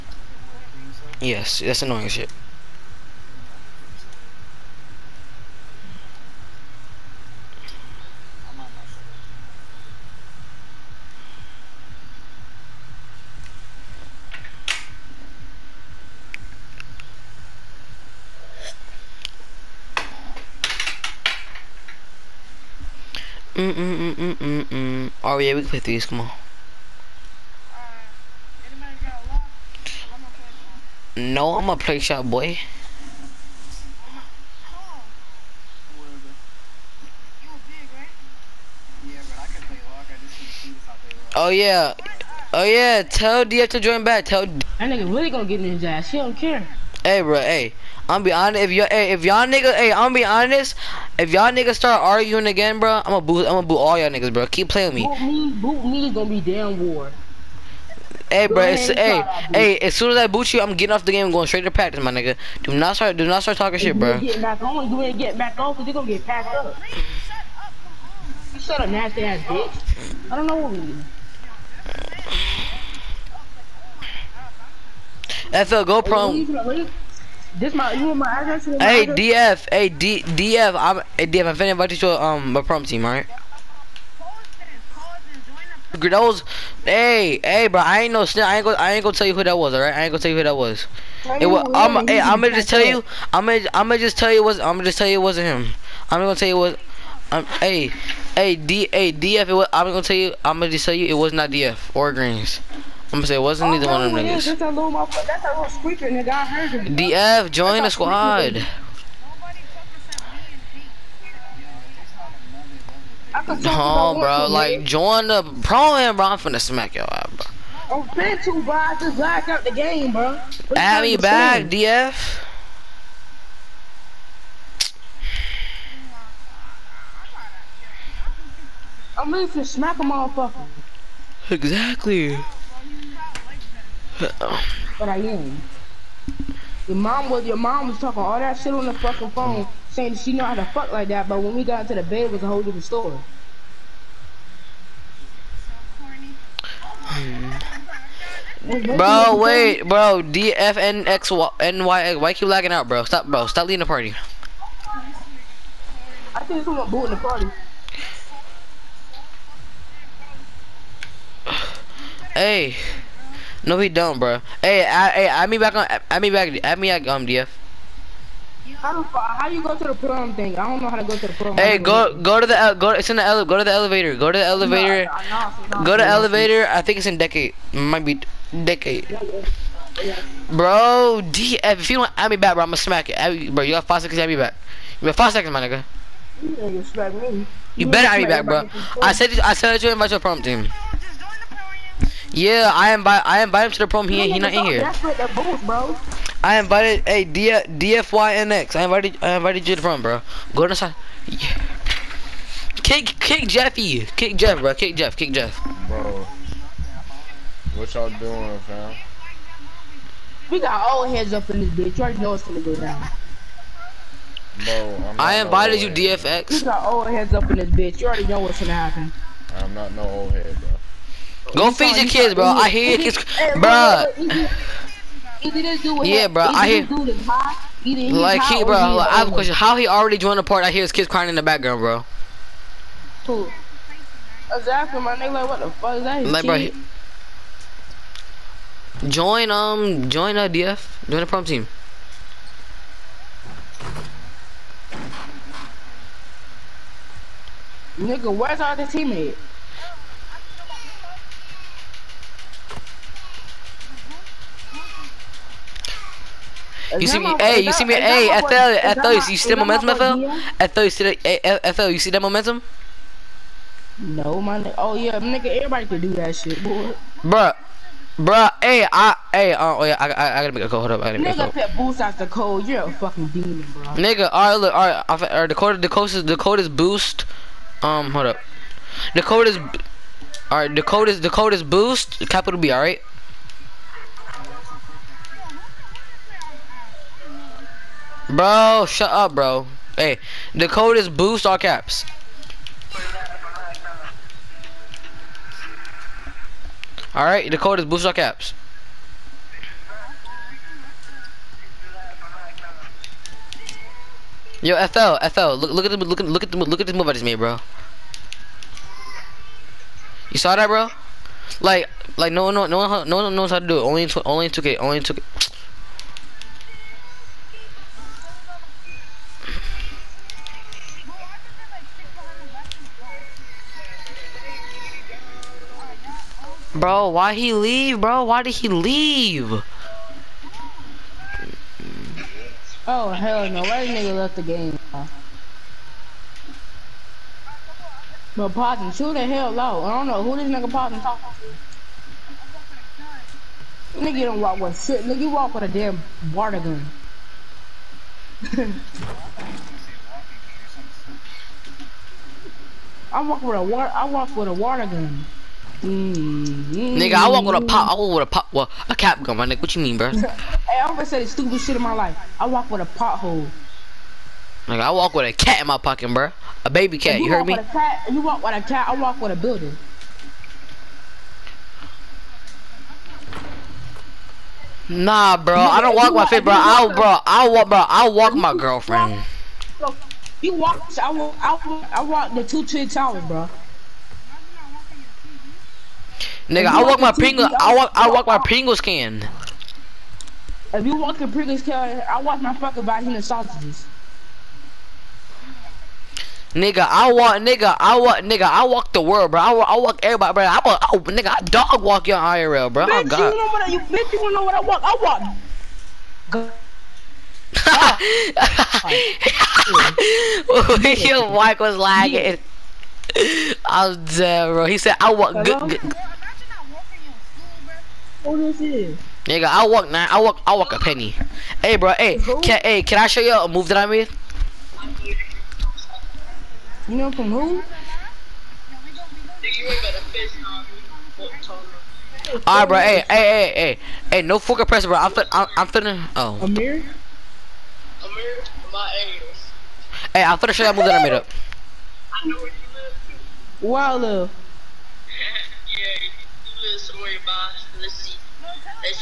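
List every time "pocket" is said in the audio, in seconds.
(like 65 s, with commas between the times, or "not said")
365 s.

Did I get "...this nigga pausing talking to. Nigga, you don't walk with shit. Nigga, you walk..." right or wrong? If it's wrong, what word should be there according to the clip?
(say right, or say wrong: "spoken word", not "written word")
right.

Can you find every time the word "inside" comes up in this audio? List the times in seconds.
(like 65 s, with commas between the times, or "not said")
200 s.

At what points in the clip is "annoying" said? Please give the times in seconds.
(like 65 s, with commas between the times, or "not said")
1 s.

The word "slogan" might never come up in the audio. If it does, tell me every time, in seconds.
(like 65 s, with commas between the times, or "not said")
not said.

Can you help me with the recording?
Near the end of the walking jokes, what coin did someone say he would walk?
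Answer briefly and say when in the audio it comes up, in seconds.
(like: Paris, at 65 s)
a penny, at 420 s.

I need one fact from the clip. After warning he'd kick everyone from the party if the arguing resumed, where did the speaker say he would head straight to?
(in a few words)
practice.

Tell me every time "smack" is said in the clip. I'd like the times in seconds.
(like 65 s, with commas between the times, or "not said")
116 s, 129 s, 182 s.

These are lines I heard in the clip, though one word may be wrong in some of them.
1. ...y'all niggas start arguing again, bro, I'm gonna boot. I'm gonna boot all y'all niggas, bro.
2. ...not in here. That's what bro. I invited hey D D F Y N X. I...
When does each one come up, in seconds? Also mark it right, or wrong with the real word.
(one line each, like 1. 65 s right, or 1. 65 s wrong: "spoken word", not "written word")
1. 51 s right
2. 194 s right.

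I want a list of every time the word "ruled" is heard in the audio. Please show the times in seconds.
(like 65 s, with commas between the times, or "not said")
not said.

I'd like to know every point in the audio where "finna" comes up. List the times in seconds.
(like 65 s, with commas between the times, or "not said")
81 s, 116 s, 435 s, 440 s.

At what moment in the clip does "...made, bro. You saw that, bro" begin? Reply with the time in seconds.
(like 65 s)
307 s.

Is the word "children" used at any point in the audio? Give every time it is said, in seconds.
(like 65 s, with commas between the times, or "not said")
not said.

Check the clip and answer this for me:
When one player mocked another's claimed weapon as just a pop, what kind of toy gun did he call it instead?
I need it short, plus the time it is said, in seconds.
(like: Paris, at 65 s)
cap gun, at 358 s.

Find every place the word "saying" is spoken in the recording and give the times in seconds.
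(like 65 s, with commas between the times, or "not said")
139 s.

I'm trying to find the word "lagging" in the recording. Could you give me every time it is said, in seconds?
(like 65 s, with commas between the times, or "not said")
152 s, 411 s.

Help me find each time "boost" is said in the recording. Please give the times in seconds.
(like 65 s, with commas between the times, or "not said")
271 s, 276 s, 281 s, 291 s, 297 s.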